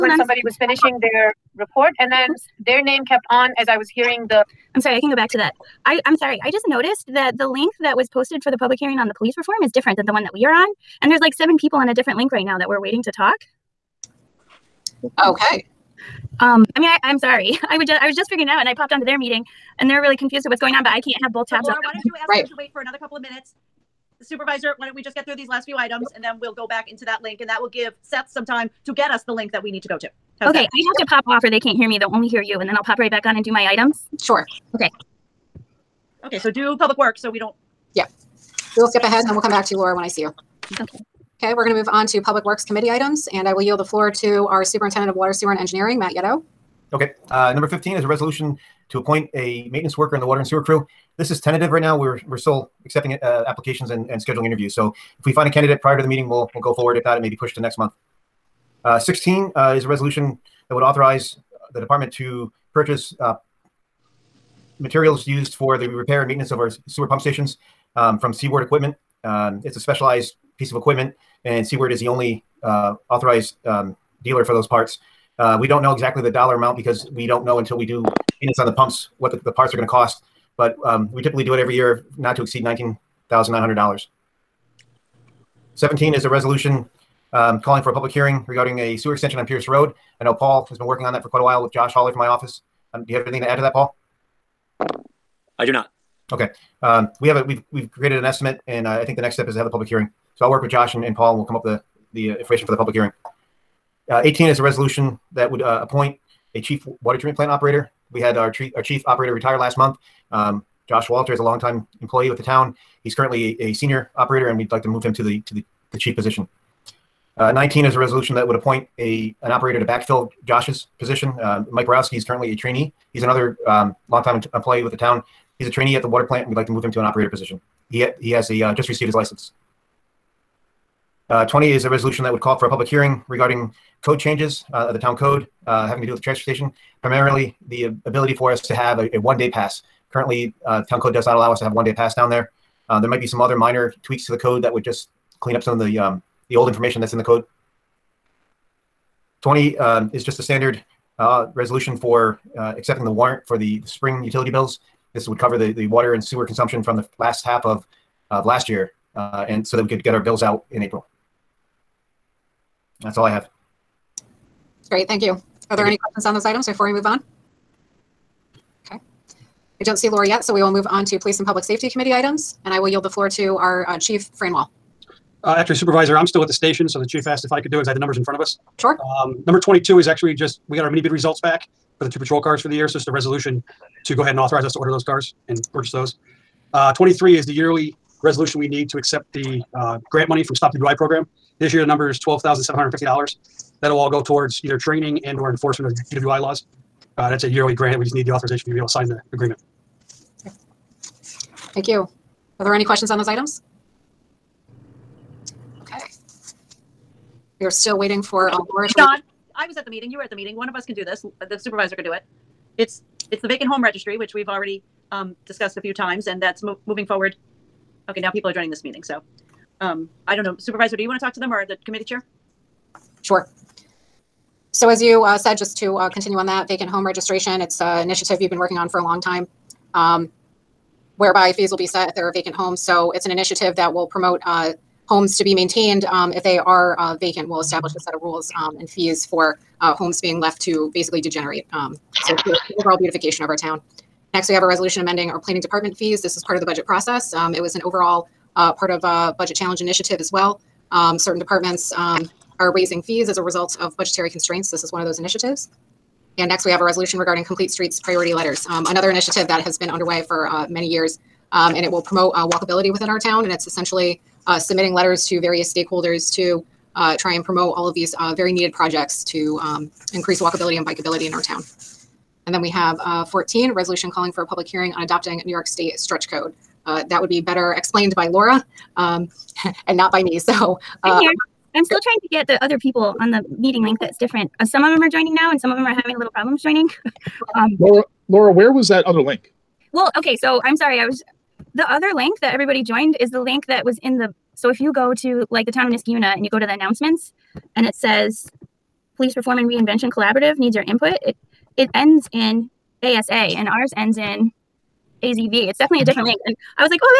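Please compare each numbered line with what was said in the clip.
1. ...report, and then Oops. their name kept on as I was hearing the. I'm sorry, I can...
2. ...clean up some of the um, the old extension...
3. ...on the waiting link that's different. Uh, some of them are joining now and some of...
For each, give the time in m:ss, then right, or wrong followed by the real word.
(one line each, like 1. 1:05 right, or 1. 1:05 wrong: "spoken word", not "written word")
1. 0:01 right
2. 2:25 wrong: "information", not "extension"
3. 4:43 wrong: "meeting", not "waiting".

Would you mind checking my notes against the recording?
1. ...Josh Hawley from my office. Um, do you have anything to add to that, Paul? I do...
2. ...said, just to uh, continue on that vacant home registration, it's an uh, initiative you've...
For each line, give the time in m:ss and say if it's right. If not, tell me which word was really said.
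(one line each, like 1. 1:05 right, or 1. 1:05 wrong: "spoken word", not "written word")
1. 1:31 right
2. 3:45 right.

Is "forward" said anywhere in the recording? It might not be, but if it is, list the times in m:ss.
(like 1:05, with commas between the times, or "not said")
0:56, 3:37.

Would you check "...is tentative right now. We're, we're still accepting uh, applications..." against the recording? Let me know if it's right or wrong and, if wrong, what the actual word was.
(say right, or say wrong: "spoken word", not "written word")
right.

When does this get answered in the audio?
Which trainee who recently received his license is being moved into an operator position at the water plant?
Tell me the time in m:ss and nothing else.
2:01.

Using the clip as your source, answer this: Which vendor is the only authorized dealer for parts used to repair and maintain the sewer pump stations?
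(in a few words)
Seaward Equipment.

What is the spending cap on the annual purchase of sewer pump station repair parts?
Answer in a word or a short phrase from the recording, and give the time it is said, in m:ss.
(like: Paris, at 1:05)
$19,900, at 1:22.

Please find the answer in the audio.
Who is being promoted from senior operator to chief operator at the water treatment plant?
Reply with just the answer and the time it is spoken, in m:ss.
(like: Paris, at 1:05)
Josh Walter, at 1:50.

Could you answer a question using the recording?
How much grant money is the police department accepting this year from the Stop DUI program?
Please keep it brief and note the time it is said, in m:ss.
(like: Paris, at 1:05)
$12,750, at 3:12.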